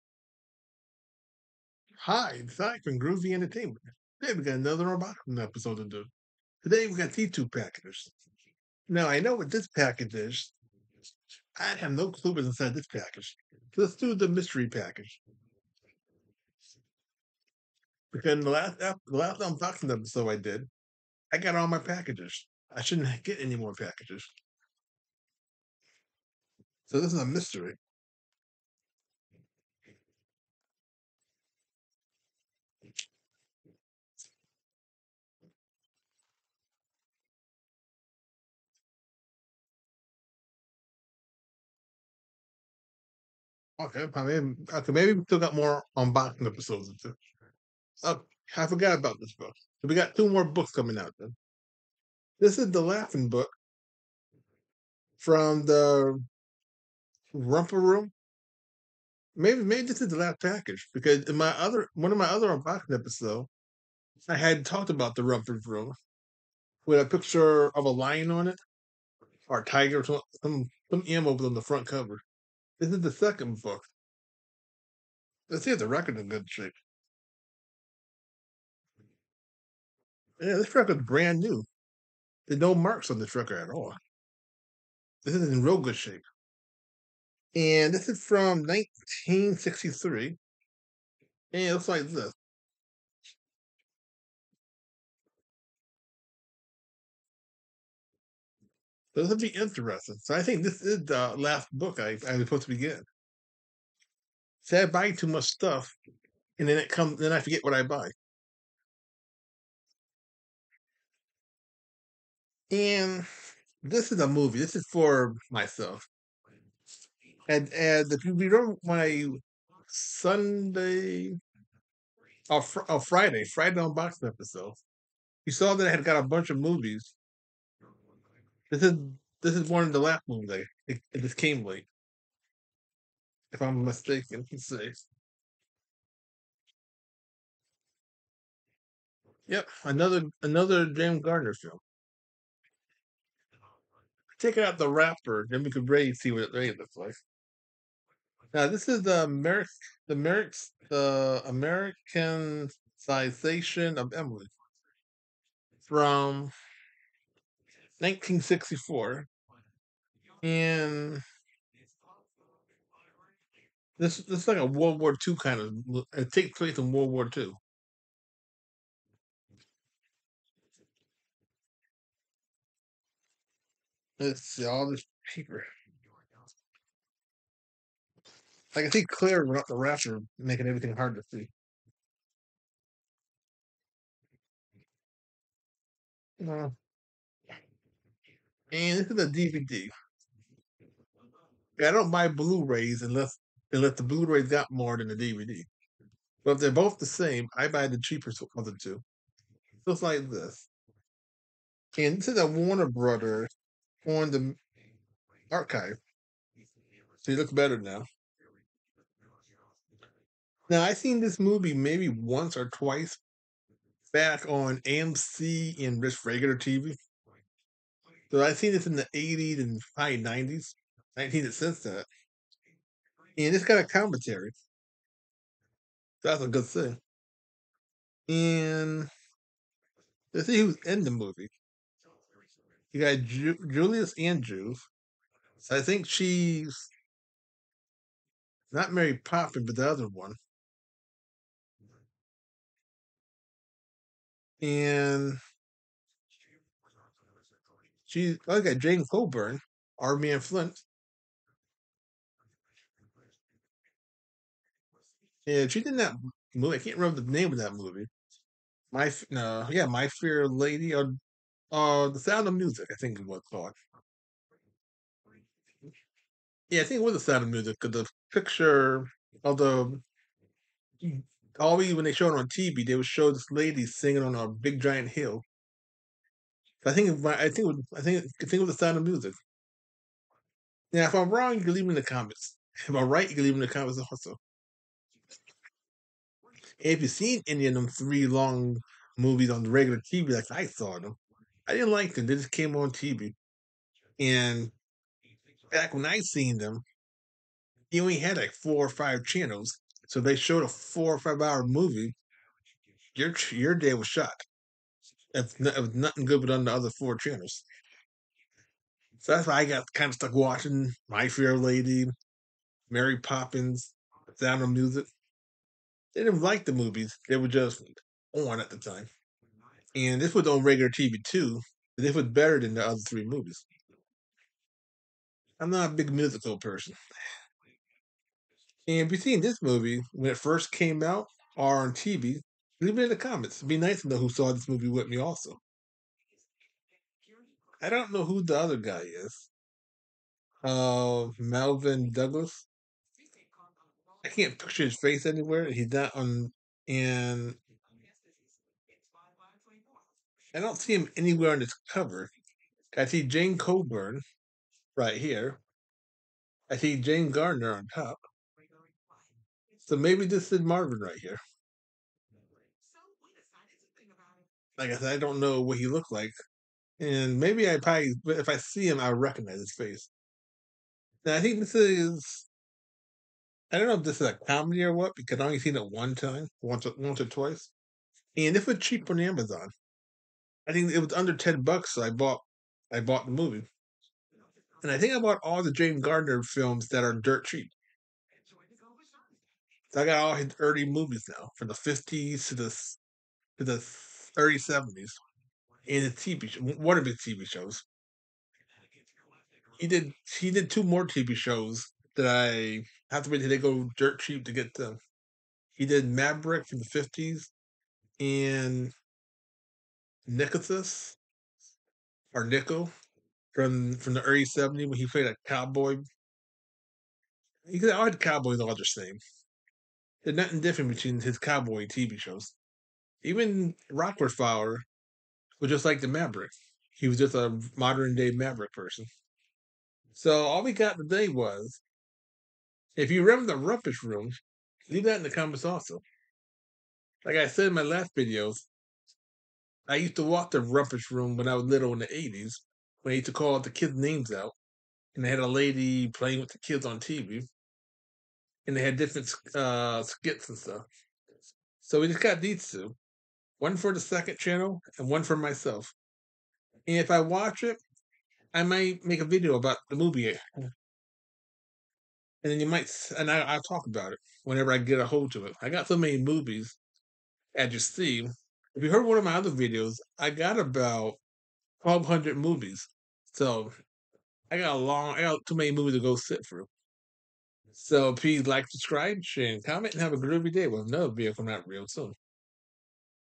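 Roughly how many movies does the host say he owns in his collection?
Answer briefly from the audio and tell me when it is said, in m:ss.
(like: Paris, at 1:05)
1200, at 7:51.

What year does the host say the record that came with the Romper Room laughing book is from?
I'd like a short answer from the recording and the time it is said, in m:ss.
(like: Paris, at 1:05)
1963, at 1:28.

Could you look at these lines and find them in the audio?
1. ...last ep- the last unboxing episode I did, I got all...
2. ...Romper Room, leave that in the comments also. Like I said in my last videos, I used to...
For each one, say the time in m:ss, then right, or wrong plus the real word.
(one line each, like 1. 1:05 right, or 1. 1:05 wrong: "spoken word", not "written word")
1. 0:18 right
2. 7:13 right.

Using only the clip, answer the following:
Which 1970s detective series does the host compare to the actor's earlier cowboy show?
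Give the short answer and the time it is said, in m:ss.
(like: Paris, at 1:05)
Rockford Files, at 7:03.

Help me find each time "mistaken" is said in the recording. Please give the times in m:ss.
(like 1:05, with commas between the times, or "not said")
2:13.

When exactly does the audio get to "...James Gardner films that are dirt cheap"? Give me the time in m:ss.
6:25.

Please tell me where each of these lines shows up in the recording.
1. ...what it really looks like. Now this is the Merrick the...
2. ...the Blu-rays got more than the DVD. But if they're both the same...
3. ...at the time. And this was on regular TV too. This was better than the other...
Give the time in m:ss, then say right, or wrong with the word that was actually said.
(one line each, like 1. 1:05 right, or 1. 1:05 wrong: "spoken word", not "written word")
1. 2:26 right
2. 3:13 right
3. 5:18 right.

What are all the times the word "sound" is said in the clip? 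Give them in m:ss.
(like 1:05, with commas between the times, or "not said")
4:22, 4:27, 4:38, 5:14.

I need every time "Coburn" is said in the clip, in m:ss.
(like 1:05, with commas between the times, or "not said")
4:09, 5:53.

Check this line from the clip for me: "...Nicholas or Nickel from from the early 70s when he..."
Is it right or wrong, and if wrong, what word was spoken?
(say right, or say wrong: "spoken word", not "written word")
right.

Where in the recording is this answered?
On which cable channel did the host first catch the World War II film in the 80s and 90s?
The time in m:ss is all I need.
3:34.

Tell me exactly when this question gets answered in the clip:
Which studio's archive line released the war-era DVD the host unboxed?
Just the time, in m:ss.
3:22.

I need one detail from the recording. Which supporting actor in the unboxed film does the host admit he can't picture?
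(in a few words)
Melvyn Douglas.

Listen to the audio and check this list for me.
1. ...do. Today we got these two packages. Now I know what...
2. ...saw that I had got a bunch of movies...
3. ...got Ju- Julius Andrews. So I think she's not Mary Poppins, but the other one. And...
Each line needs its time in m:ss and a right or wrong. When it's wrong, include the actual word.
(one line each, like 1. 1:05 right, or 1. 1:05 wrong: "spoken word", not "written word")
1. 0:05 right
2. 2:05 right
3. 3:53 right.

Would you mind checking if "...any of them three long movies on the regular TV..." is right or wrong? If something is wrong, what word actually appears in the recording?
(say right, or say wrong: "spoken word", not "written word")
right.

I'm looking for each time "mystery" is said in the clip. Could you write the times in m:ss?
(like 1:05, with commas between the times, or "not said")
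0:14, 0:27.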